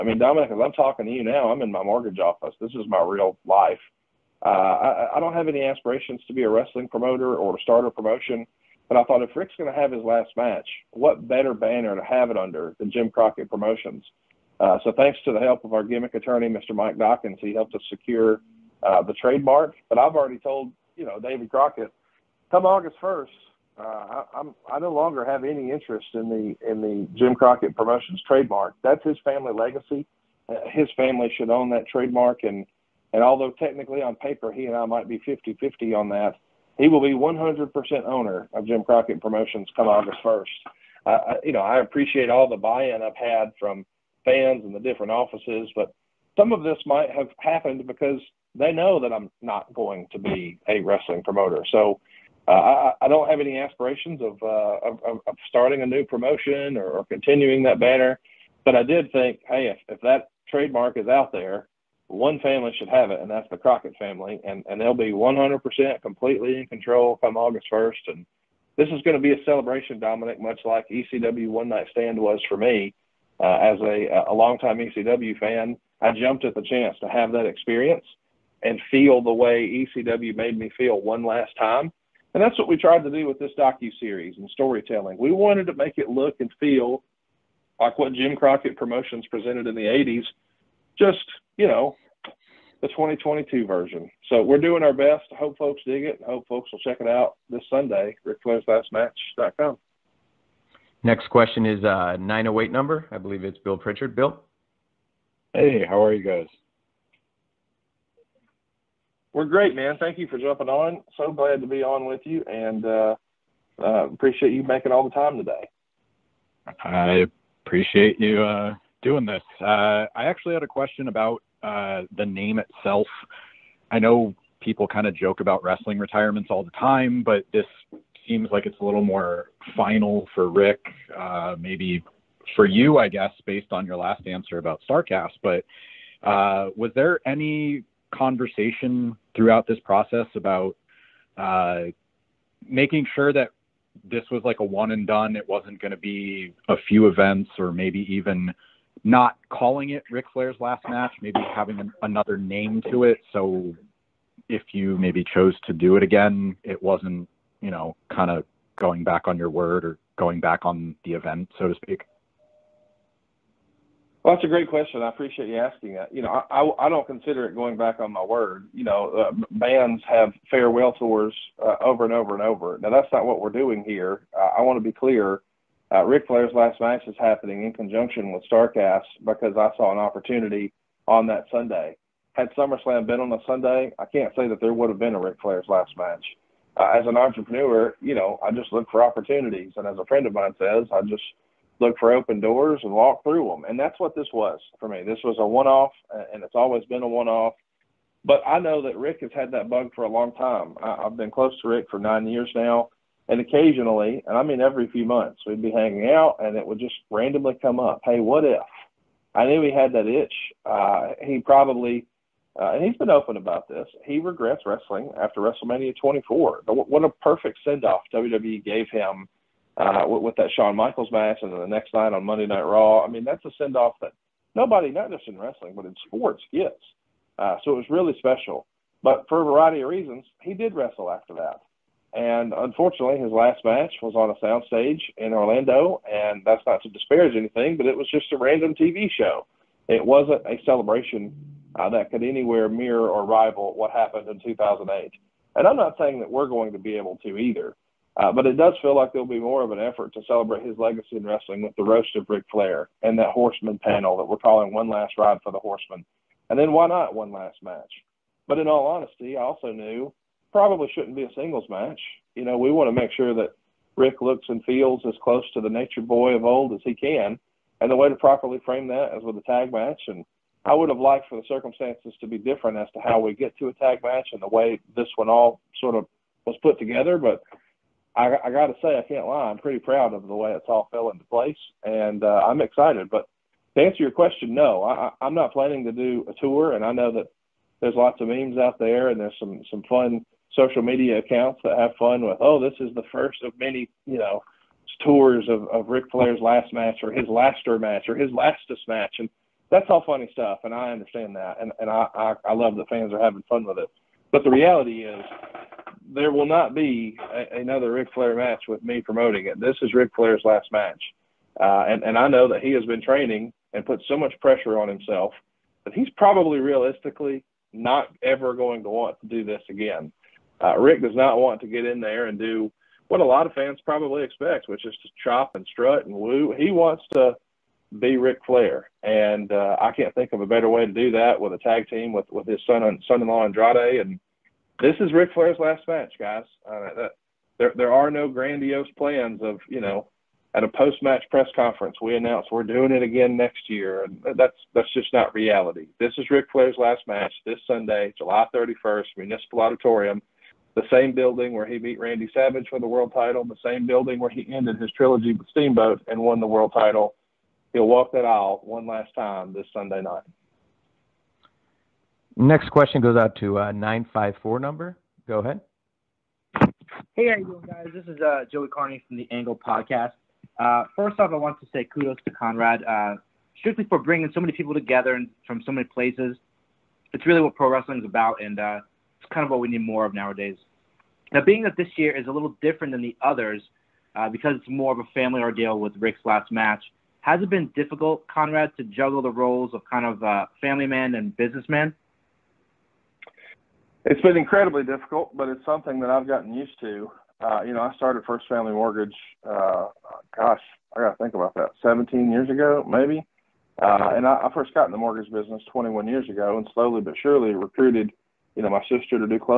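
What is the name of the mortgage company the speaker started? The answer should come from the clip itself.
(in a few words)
First Family Mortgage.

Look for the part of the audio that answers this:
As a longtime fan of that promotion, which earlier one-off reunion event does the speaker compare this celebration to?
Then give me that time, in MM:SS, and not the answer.
01:10.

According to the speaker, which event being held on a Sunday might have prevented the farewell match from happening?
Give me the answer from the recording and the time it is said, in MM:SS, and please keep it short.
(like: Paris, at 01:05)
SummerSlam, at 03:02.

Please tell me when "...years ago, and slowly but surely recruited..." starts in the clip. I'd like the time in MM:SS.
06:46.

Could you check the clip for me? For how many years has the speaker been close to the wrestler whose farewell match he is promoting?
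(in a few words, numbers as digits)
9.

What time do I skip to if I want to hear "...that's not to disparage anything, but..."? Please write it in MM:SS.
03:56.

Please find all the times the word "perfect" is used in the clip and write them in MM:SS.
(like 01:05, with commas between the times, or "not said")
03:37.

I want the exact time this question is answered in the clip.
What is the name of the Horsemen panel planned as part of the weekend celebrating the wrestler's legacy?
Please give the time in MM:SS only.
04:14.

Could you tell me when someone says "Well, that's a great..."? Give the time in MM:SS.
02:44.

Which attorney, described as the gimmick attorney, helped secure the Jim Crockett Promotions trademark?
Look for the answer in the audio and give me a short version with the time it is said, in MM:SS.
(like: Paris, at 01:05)
Mike Dawkins, at 00:16.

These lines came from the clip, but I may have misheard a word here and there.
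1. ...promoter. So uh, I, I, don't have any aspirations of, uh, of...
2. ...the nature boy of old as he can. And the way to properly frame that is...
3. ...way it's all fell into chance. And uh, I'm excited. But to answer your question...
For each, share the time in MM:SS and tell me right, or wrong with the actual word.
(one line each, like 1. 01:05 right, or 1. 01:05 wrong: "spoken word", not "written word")
1. 00:51 right
2. 04:25 right
3. 04:40 wrong: "place", not "chance".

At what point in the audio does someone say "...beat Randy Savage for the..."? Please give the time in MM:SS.
05:51.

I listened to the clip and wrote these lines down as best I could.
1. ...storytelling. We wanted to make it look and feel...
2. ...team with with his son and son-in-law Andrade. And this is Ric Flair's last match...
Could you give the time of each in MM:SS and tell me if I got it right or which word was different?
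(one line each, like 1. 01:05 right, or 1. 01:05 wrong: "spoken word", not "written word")
1. 01:24 right
2. 05:31 right.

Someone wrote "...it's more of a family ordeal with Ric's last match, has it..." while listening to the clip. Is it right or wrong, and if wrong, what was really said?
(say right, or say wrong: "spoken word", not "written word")
right.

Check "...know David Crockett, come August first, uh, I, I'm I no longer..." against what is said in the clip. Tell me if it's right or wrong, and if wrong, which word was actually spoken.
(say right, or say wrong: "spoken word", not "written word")
right.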